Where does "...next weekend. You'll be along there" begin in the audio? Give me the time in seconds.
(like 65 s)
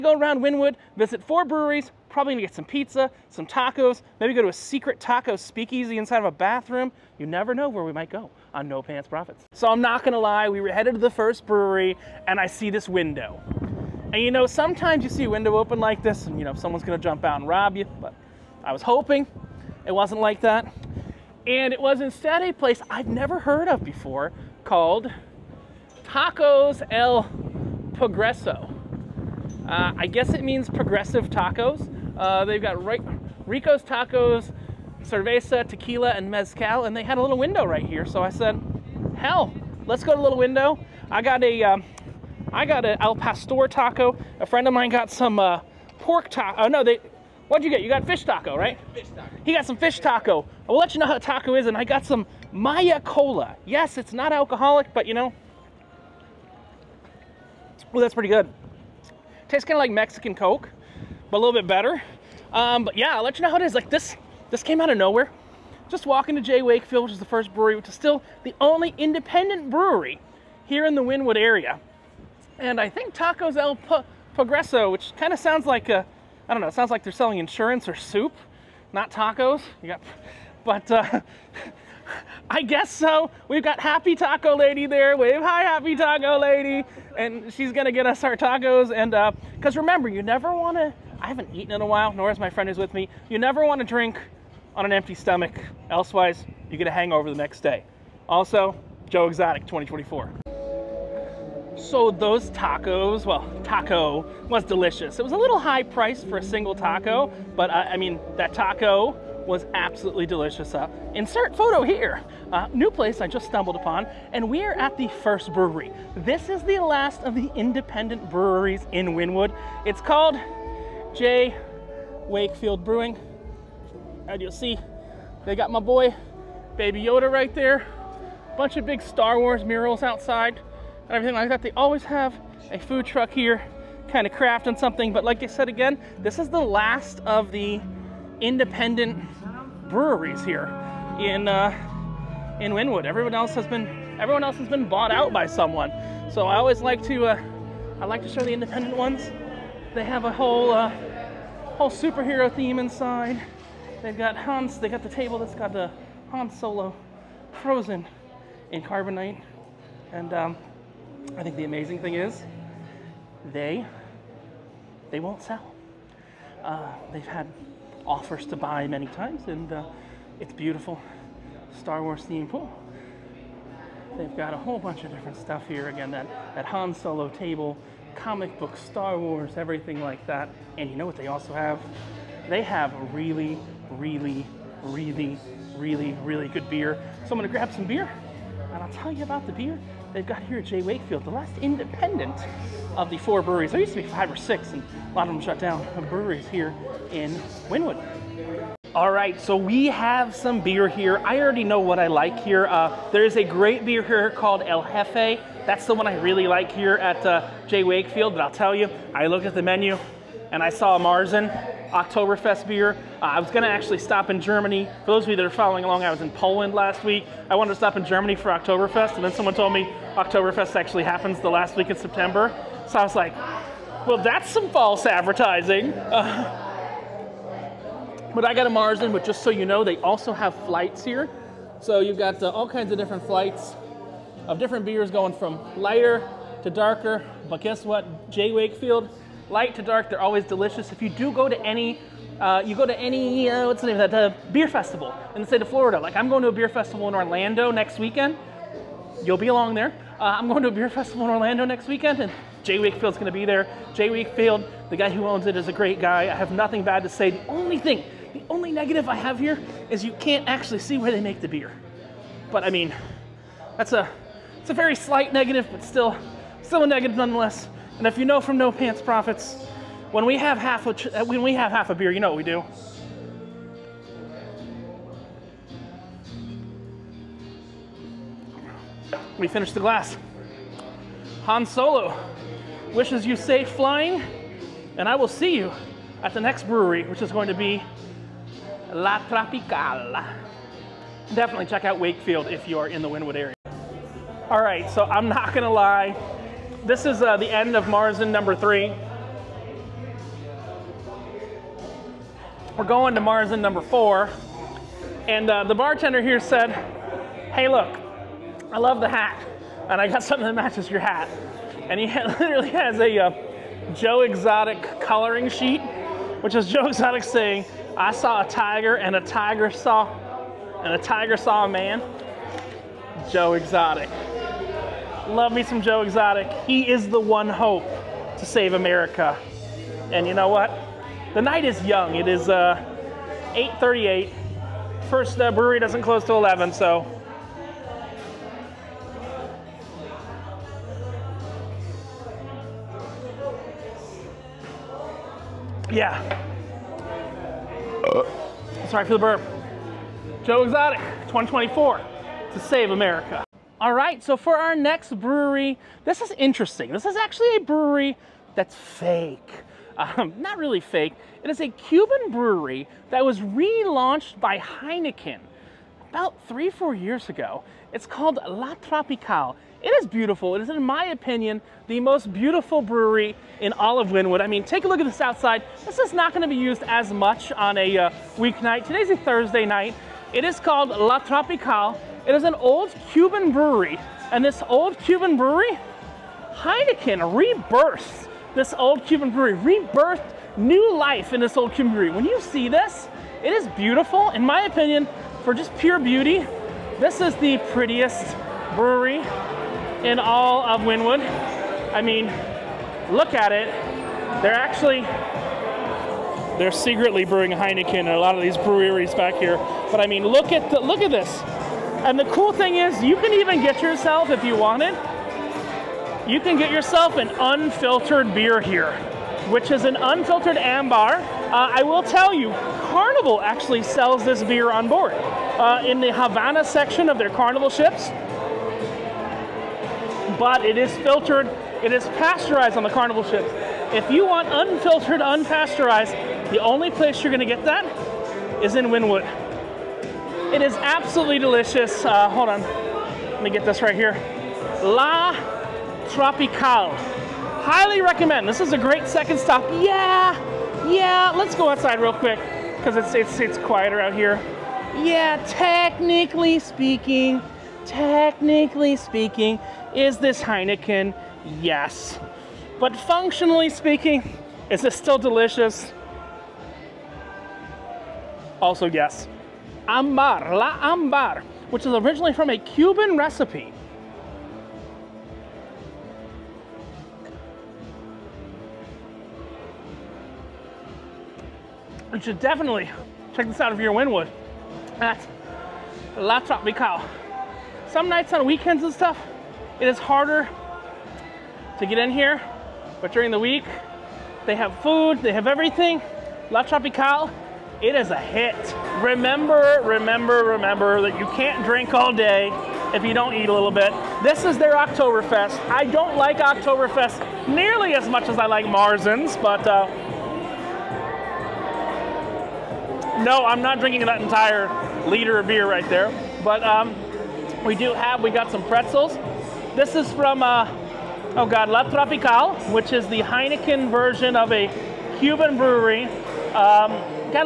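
247 s.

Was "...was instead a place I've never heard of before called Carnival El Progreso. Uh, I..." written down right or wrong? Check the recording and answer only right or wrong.
wrong.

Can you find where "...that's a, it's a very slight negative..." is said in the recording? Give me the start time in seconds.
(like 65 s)
263 s.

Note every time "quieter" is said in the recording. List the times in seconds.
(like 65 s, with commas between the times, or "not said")
453 s.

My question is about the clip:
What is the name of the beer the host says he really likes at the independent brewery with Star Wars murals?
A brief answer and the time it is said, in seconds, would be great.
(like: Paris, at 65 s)
El Jefe, at 204 s.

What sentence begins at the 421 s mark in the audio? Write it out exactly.
Uh, I will tell you, Carnival actually sells this beer on board.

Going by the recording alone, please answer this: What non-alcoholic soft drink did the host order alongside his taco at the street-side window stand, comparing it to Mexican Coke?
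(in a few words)
Maya Cola.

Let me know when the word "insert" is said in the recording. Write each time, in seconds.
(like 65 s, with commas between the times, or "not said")
111 s.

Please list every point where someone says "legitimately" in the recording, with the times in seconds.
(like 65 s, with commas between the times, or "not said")
not said.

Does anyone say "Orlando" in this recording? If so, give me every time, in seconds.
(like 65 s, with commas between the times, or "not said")
247 s, 251 s.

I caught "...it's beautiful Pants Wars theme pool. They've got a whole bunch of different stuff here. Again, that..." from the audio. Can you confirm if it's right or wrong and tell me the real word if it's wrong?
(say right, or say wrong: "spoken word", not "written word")
wrong: "Star", not "Pants".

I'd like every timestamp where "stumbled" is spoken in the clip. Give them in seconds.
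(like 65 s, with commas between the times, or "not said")
113 s.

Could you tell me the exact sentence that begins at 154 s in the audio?
They've got Hans, they got the table that's got the Han Solo frozen in carbonite.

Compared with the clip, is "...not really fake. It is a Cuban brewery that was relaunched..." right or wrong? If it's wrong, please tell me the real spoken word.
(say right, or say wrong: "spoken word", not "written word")
right.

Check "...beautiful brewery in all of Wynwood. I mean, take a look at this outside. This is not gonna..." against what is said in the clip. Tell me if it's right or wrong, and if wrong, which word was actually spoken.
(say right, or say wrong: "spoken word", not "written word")
right.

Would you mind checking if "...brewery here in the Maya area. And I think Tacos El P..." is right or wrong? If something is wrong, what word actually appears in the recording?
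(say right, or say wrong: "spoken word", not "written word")
wrong: "Wynwood", not "Maya".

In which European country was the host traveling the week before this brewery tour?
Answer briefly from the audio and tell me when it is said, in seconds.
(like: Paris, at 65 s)
Poland, at 216 s.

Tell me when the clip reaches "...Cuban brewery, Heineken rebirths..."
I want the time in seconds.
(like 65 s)
384 s.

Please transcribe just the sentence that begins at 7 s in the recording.
You never know where we might go on No Pants Profits.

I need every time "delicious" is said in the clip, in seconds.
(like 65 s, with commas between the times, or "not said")
104 s, 110 s, 240 s, 441 s, 465 s.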